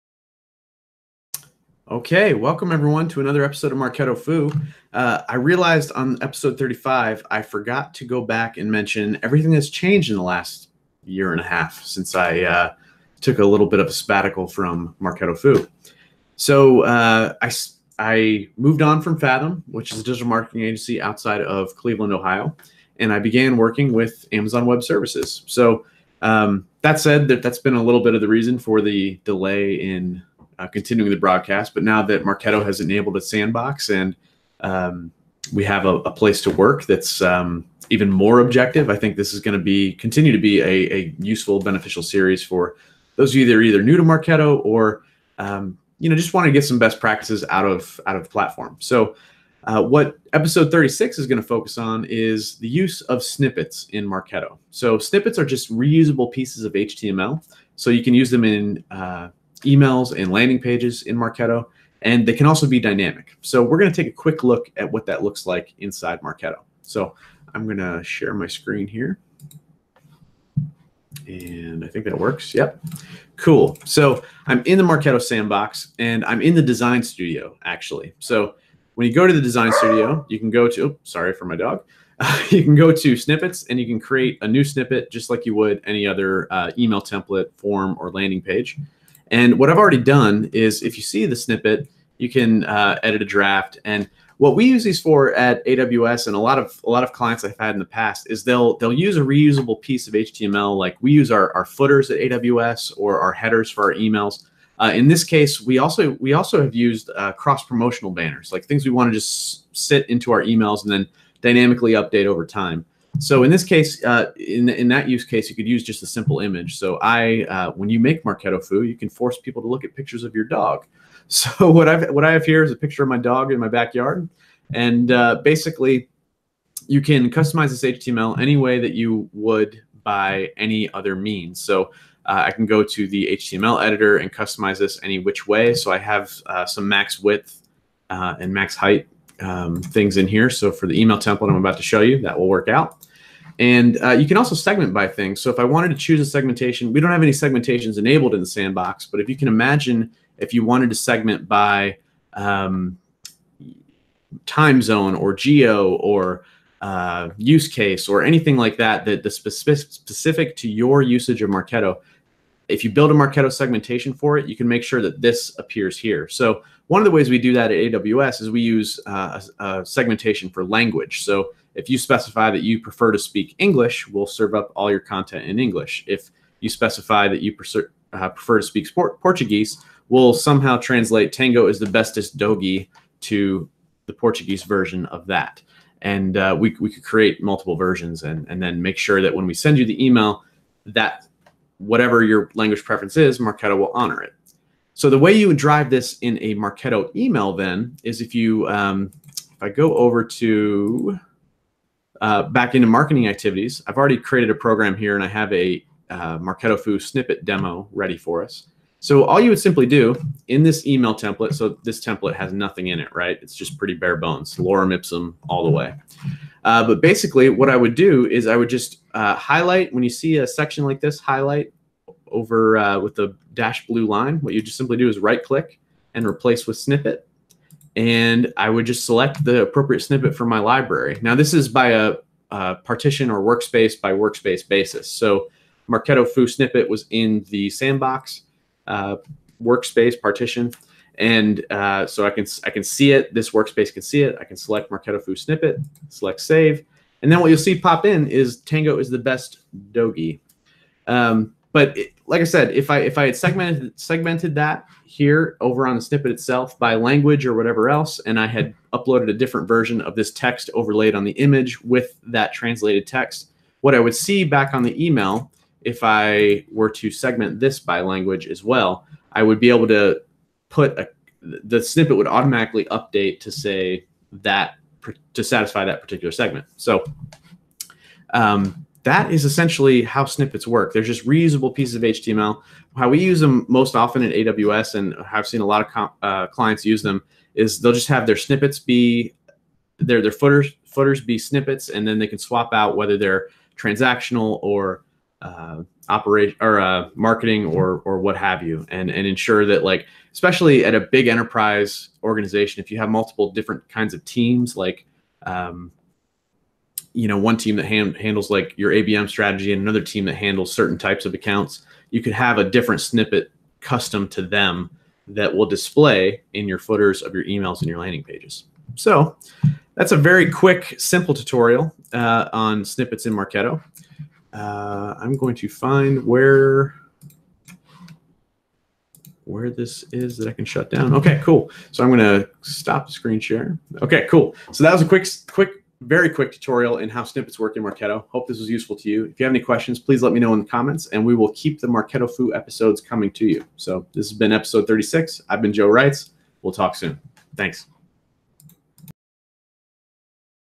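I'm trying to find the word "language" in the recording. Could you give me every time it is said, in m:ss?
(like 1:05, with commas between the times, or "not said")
2:50, 3:12, 4:16, 4:28.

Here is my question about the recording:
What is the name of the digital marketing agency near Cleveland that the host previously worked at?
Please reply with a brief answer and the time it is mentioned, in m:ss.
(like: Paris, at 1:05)
Fathom, at 0:19.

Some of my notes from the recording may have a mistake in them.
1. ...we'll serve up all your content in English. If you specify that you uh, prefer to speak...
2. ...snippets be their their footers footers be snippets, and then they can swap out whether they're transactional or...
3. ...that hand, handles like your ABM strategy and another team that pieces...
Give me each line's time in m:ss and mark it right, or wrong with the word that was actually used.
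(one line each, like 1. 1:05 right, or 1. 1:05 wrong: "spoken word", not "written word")
1. 2:54 right
2. 4:48 right
3. 5:07 wrong: "handles", not "pieces".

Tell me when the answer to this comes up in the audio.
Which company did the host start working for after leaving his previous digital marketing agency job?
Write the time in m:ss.
0:24.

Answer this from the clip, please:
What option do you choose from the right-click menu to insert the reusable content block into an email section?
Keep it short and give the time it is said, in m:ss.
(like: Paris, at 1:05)
Replace with snippet, at 3:46.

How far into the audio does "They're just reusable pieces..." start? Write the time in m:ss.
4:40.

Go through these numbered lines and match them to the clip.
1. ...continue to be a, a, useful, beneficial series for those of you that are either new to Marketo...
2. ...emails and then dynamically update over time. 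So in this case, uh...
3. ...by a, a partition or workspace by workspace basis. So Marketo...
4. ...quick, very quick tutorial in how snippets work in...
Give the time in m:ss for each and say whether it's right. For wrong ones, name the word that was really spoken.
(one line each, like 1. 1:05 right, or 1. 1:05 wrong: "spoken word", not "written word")
1. 0:39 right
2. 1:50 right
3. 3:51 right
4. 5:35 right.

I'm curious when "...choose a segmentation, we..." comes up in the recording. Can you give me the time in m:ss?
2:25.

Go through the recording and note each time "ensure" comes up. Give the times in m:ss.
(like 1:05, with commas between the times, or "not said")
4:59.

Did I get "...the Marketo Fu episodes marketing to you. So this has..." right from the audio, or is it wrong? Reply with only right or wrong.
wrong.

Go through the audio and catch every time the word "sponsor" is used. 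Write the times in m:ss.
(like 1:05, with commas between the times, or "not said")
not said.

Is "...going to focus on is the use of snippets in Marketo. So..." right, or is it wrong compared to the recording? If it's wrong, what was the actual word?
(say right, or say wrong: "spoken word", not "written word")
right.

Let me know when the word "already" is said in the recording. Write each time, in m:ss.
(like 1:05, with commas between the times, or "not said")
1:29, 3:23.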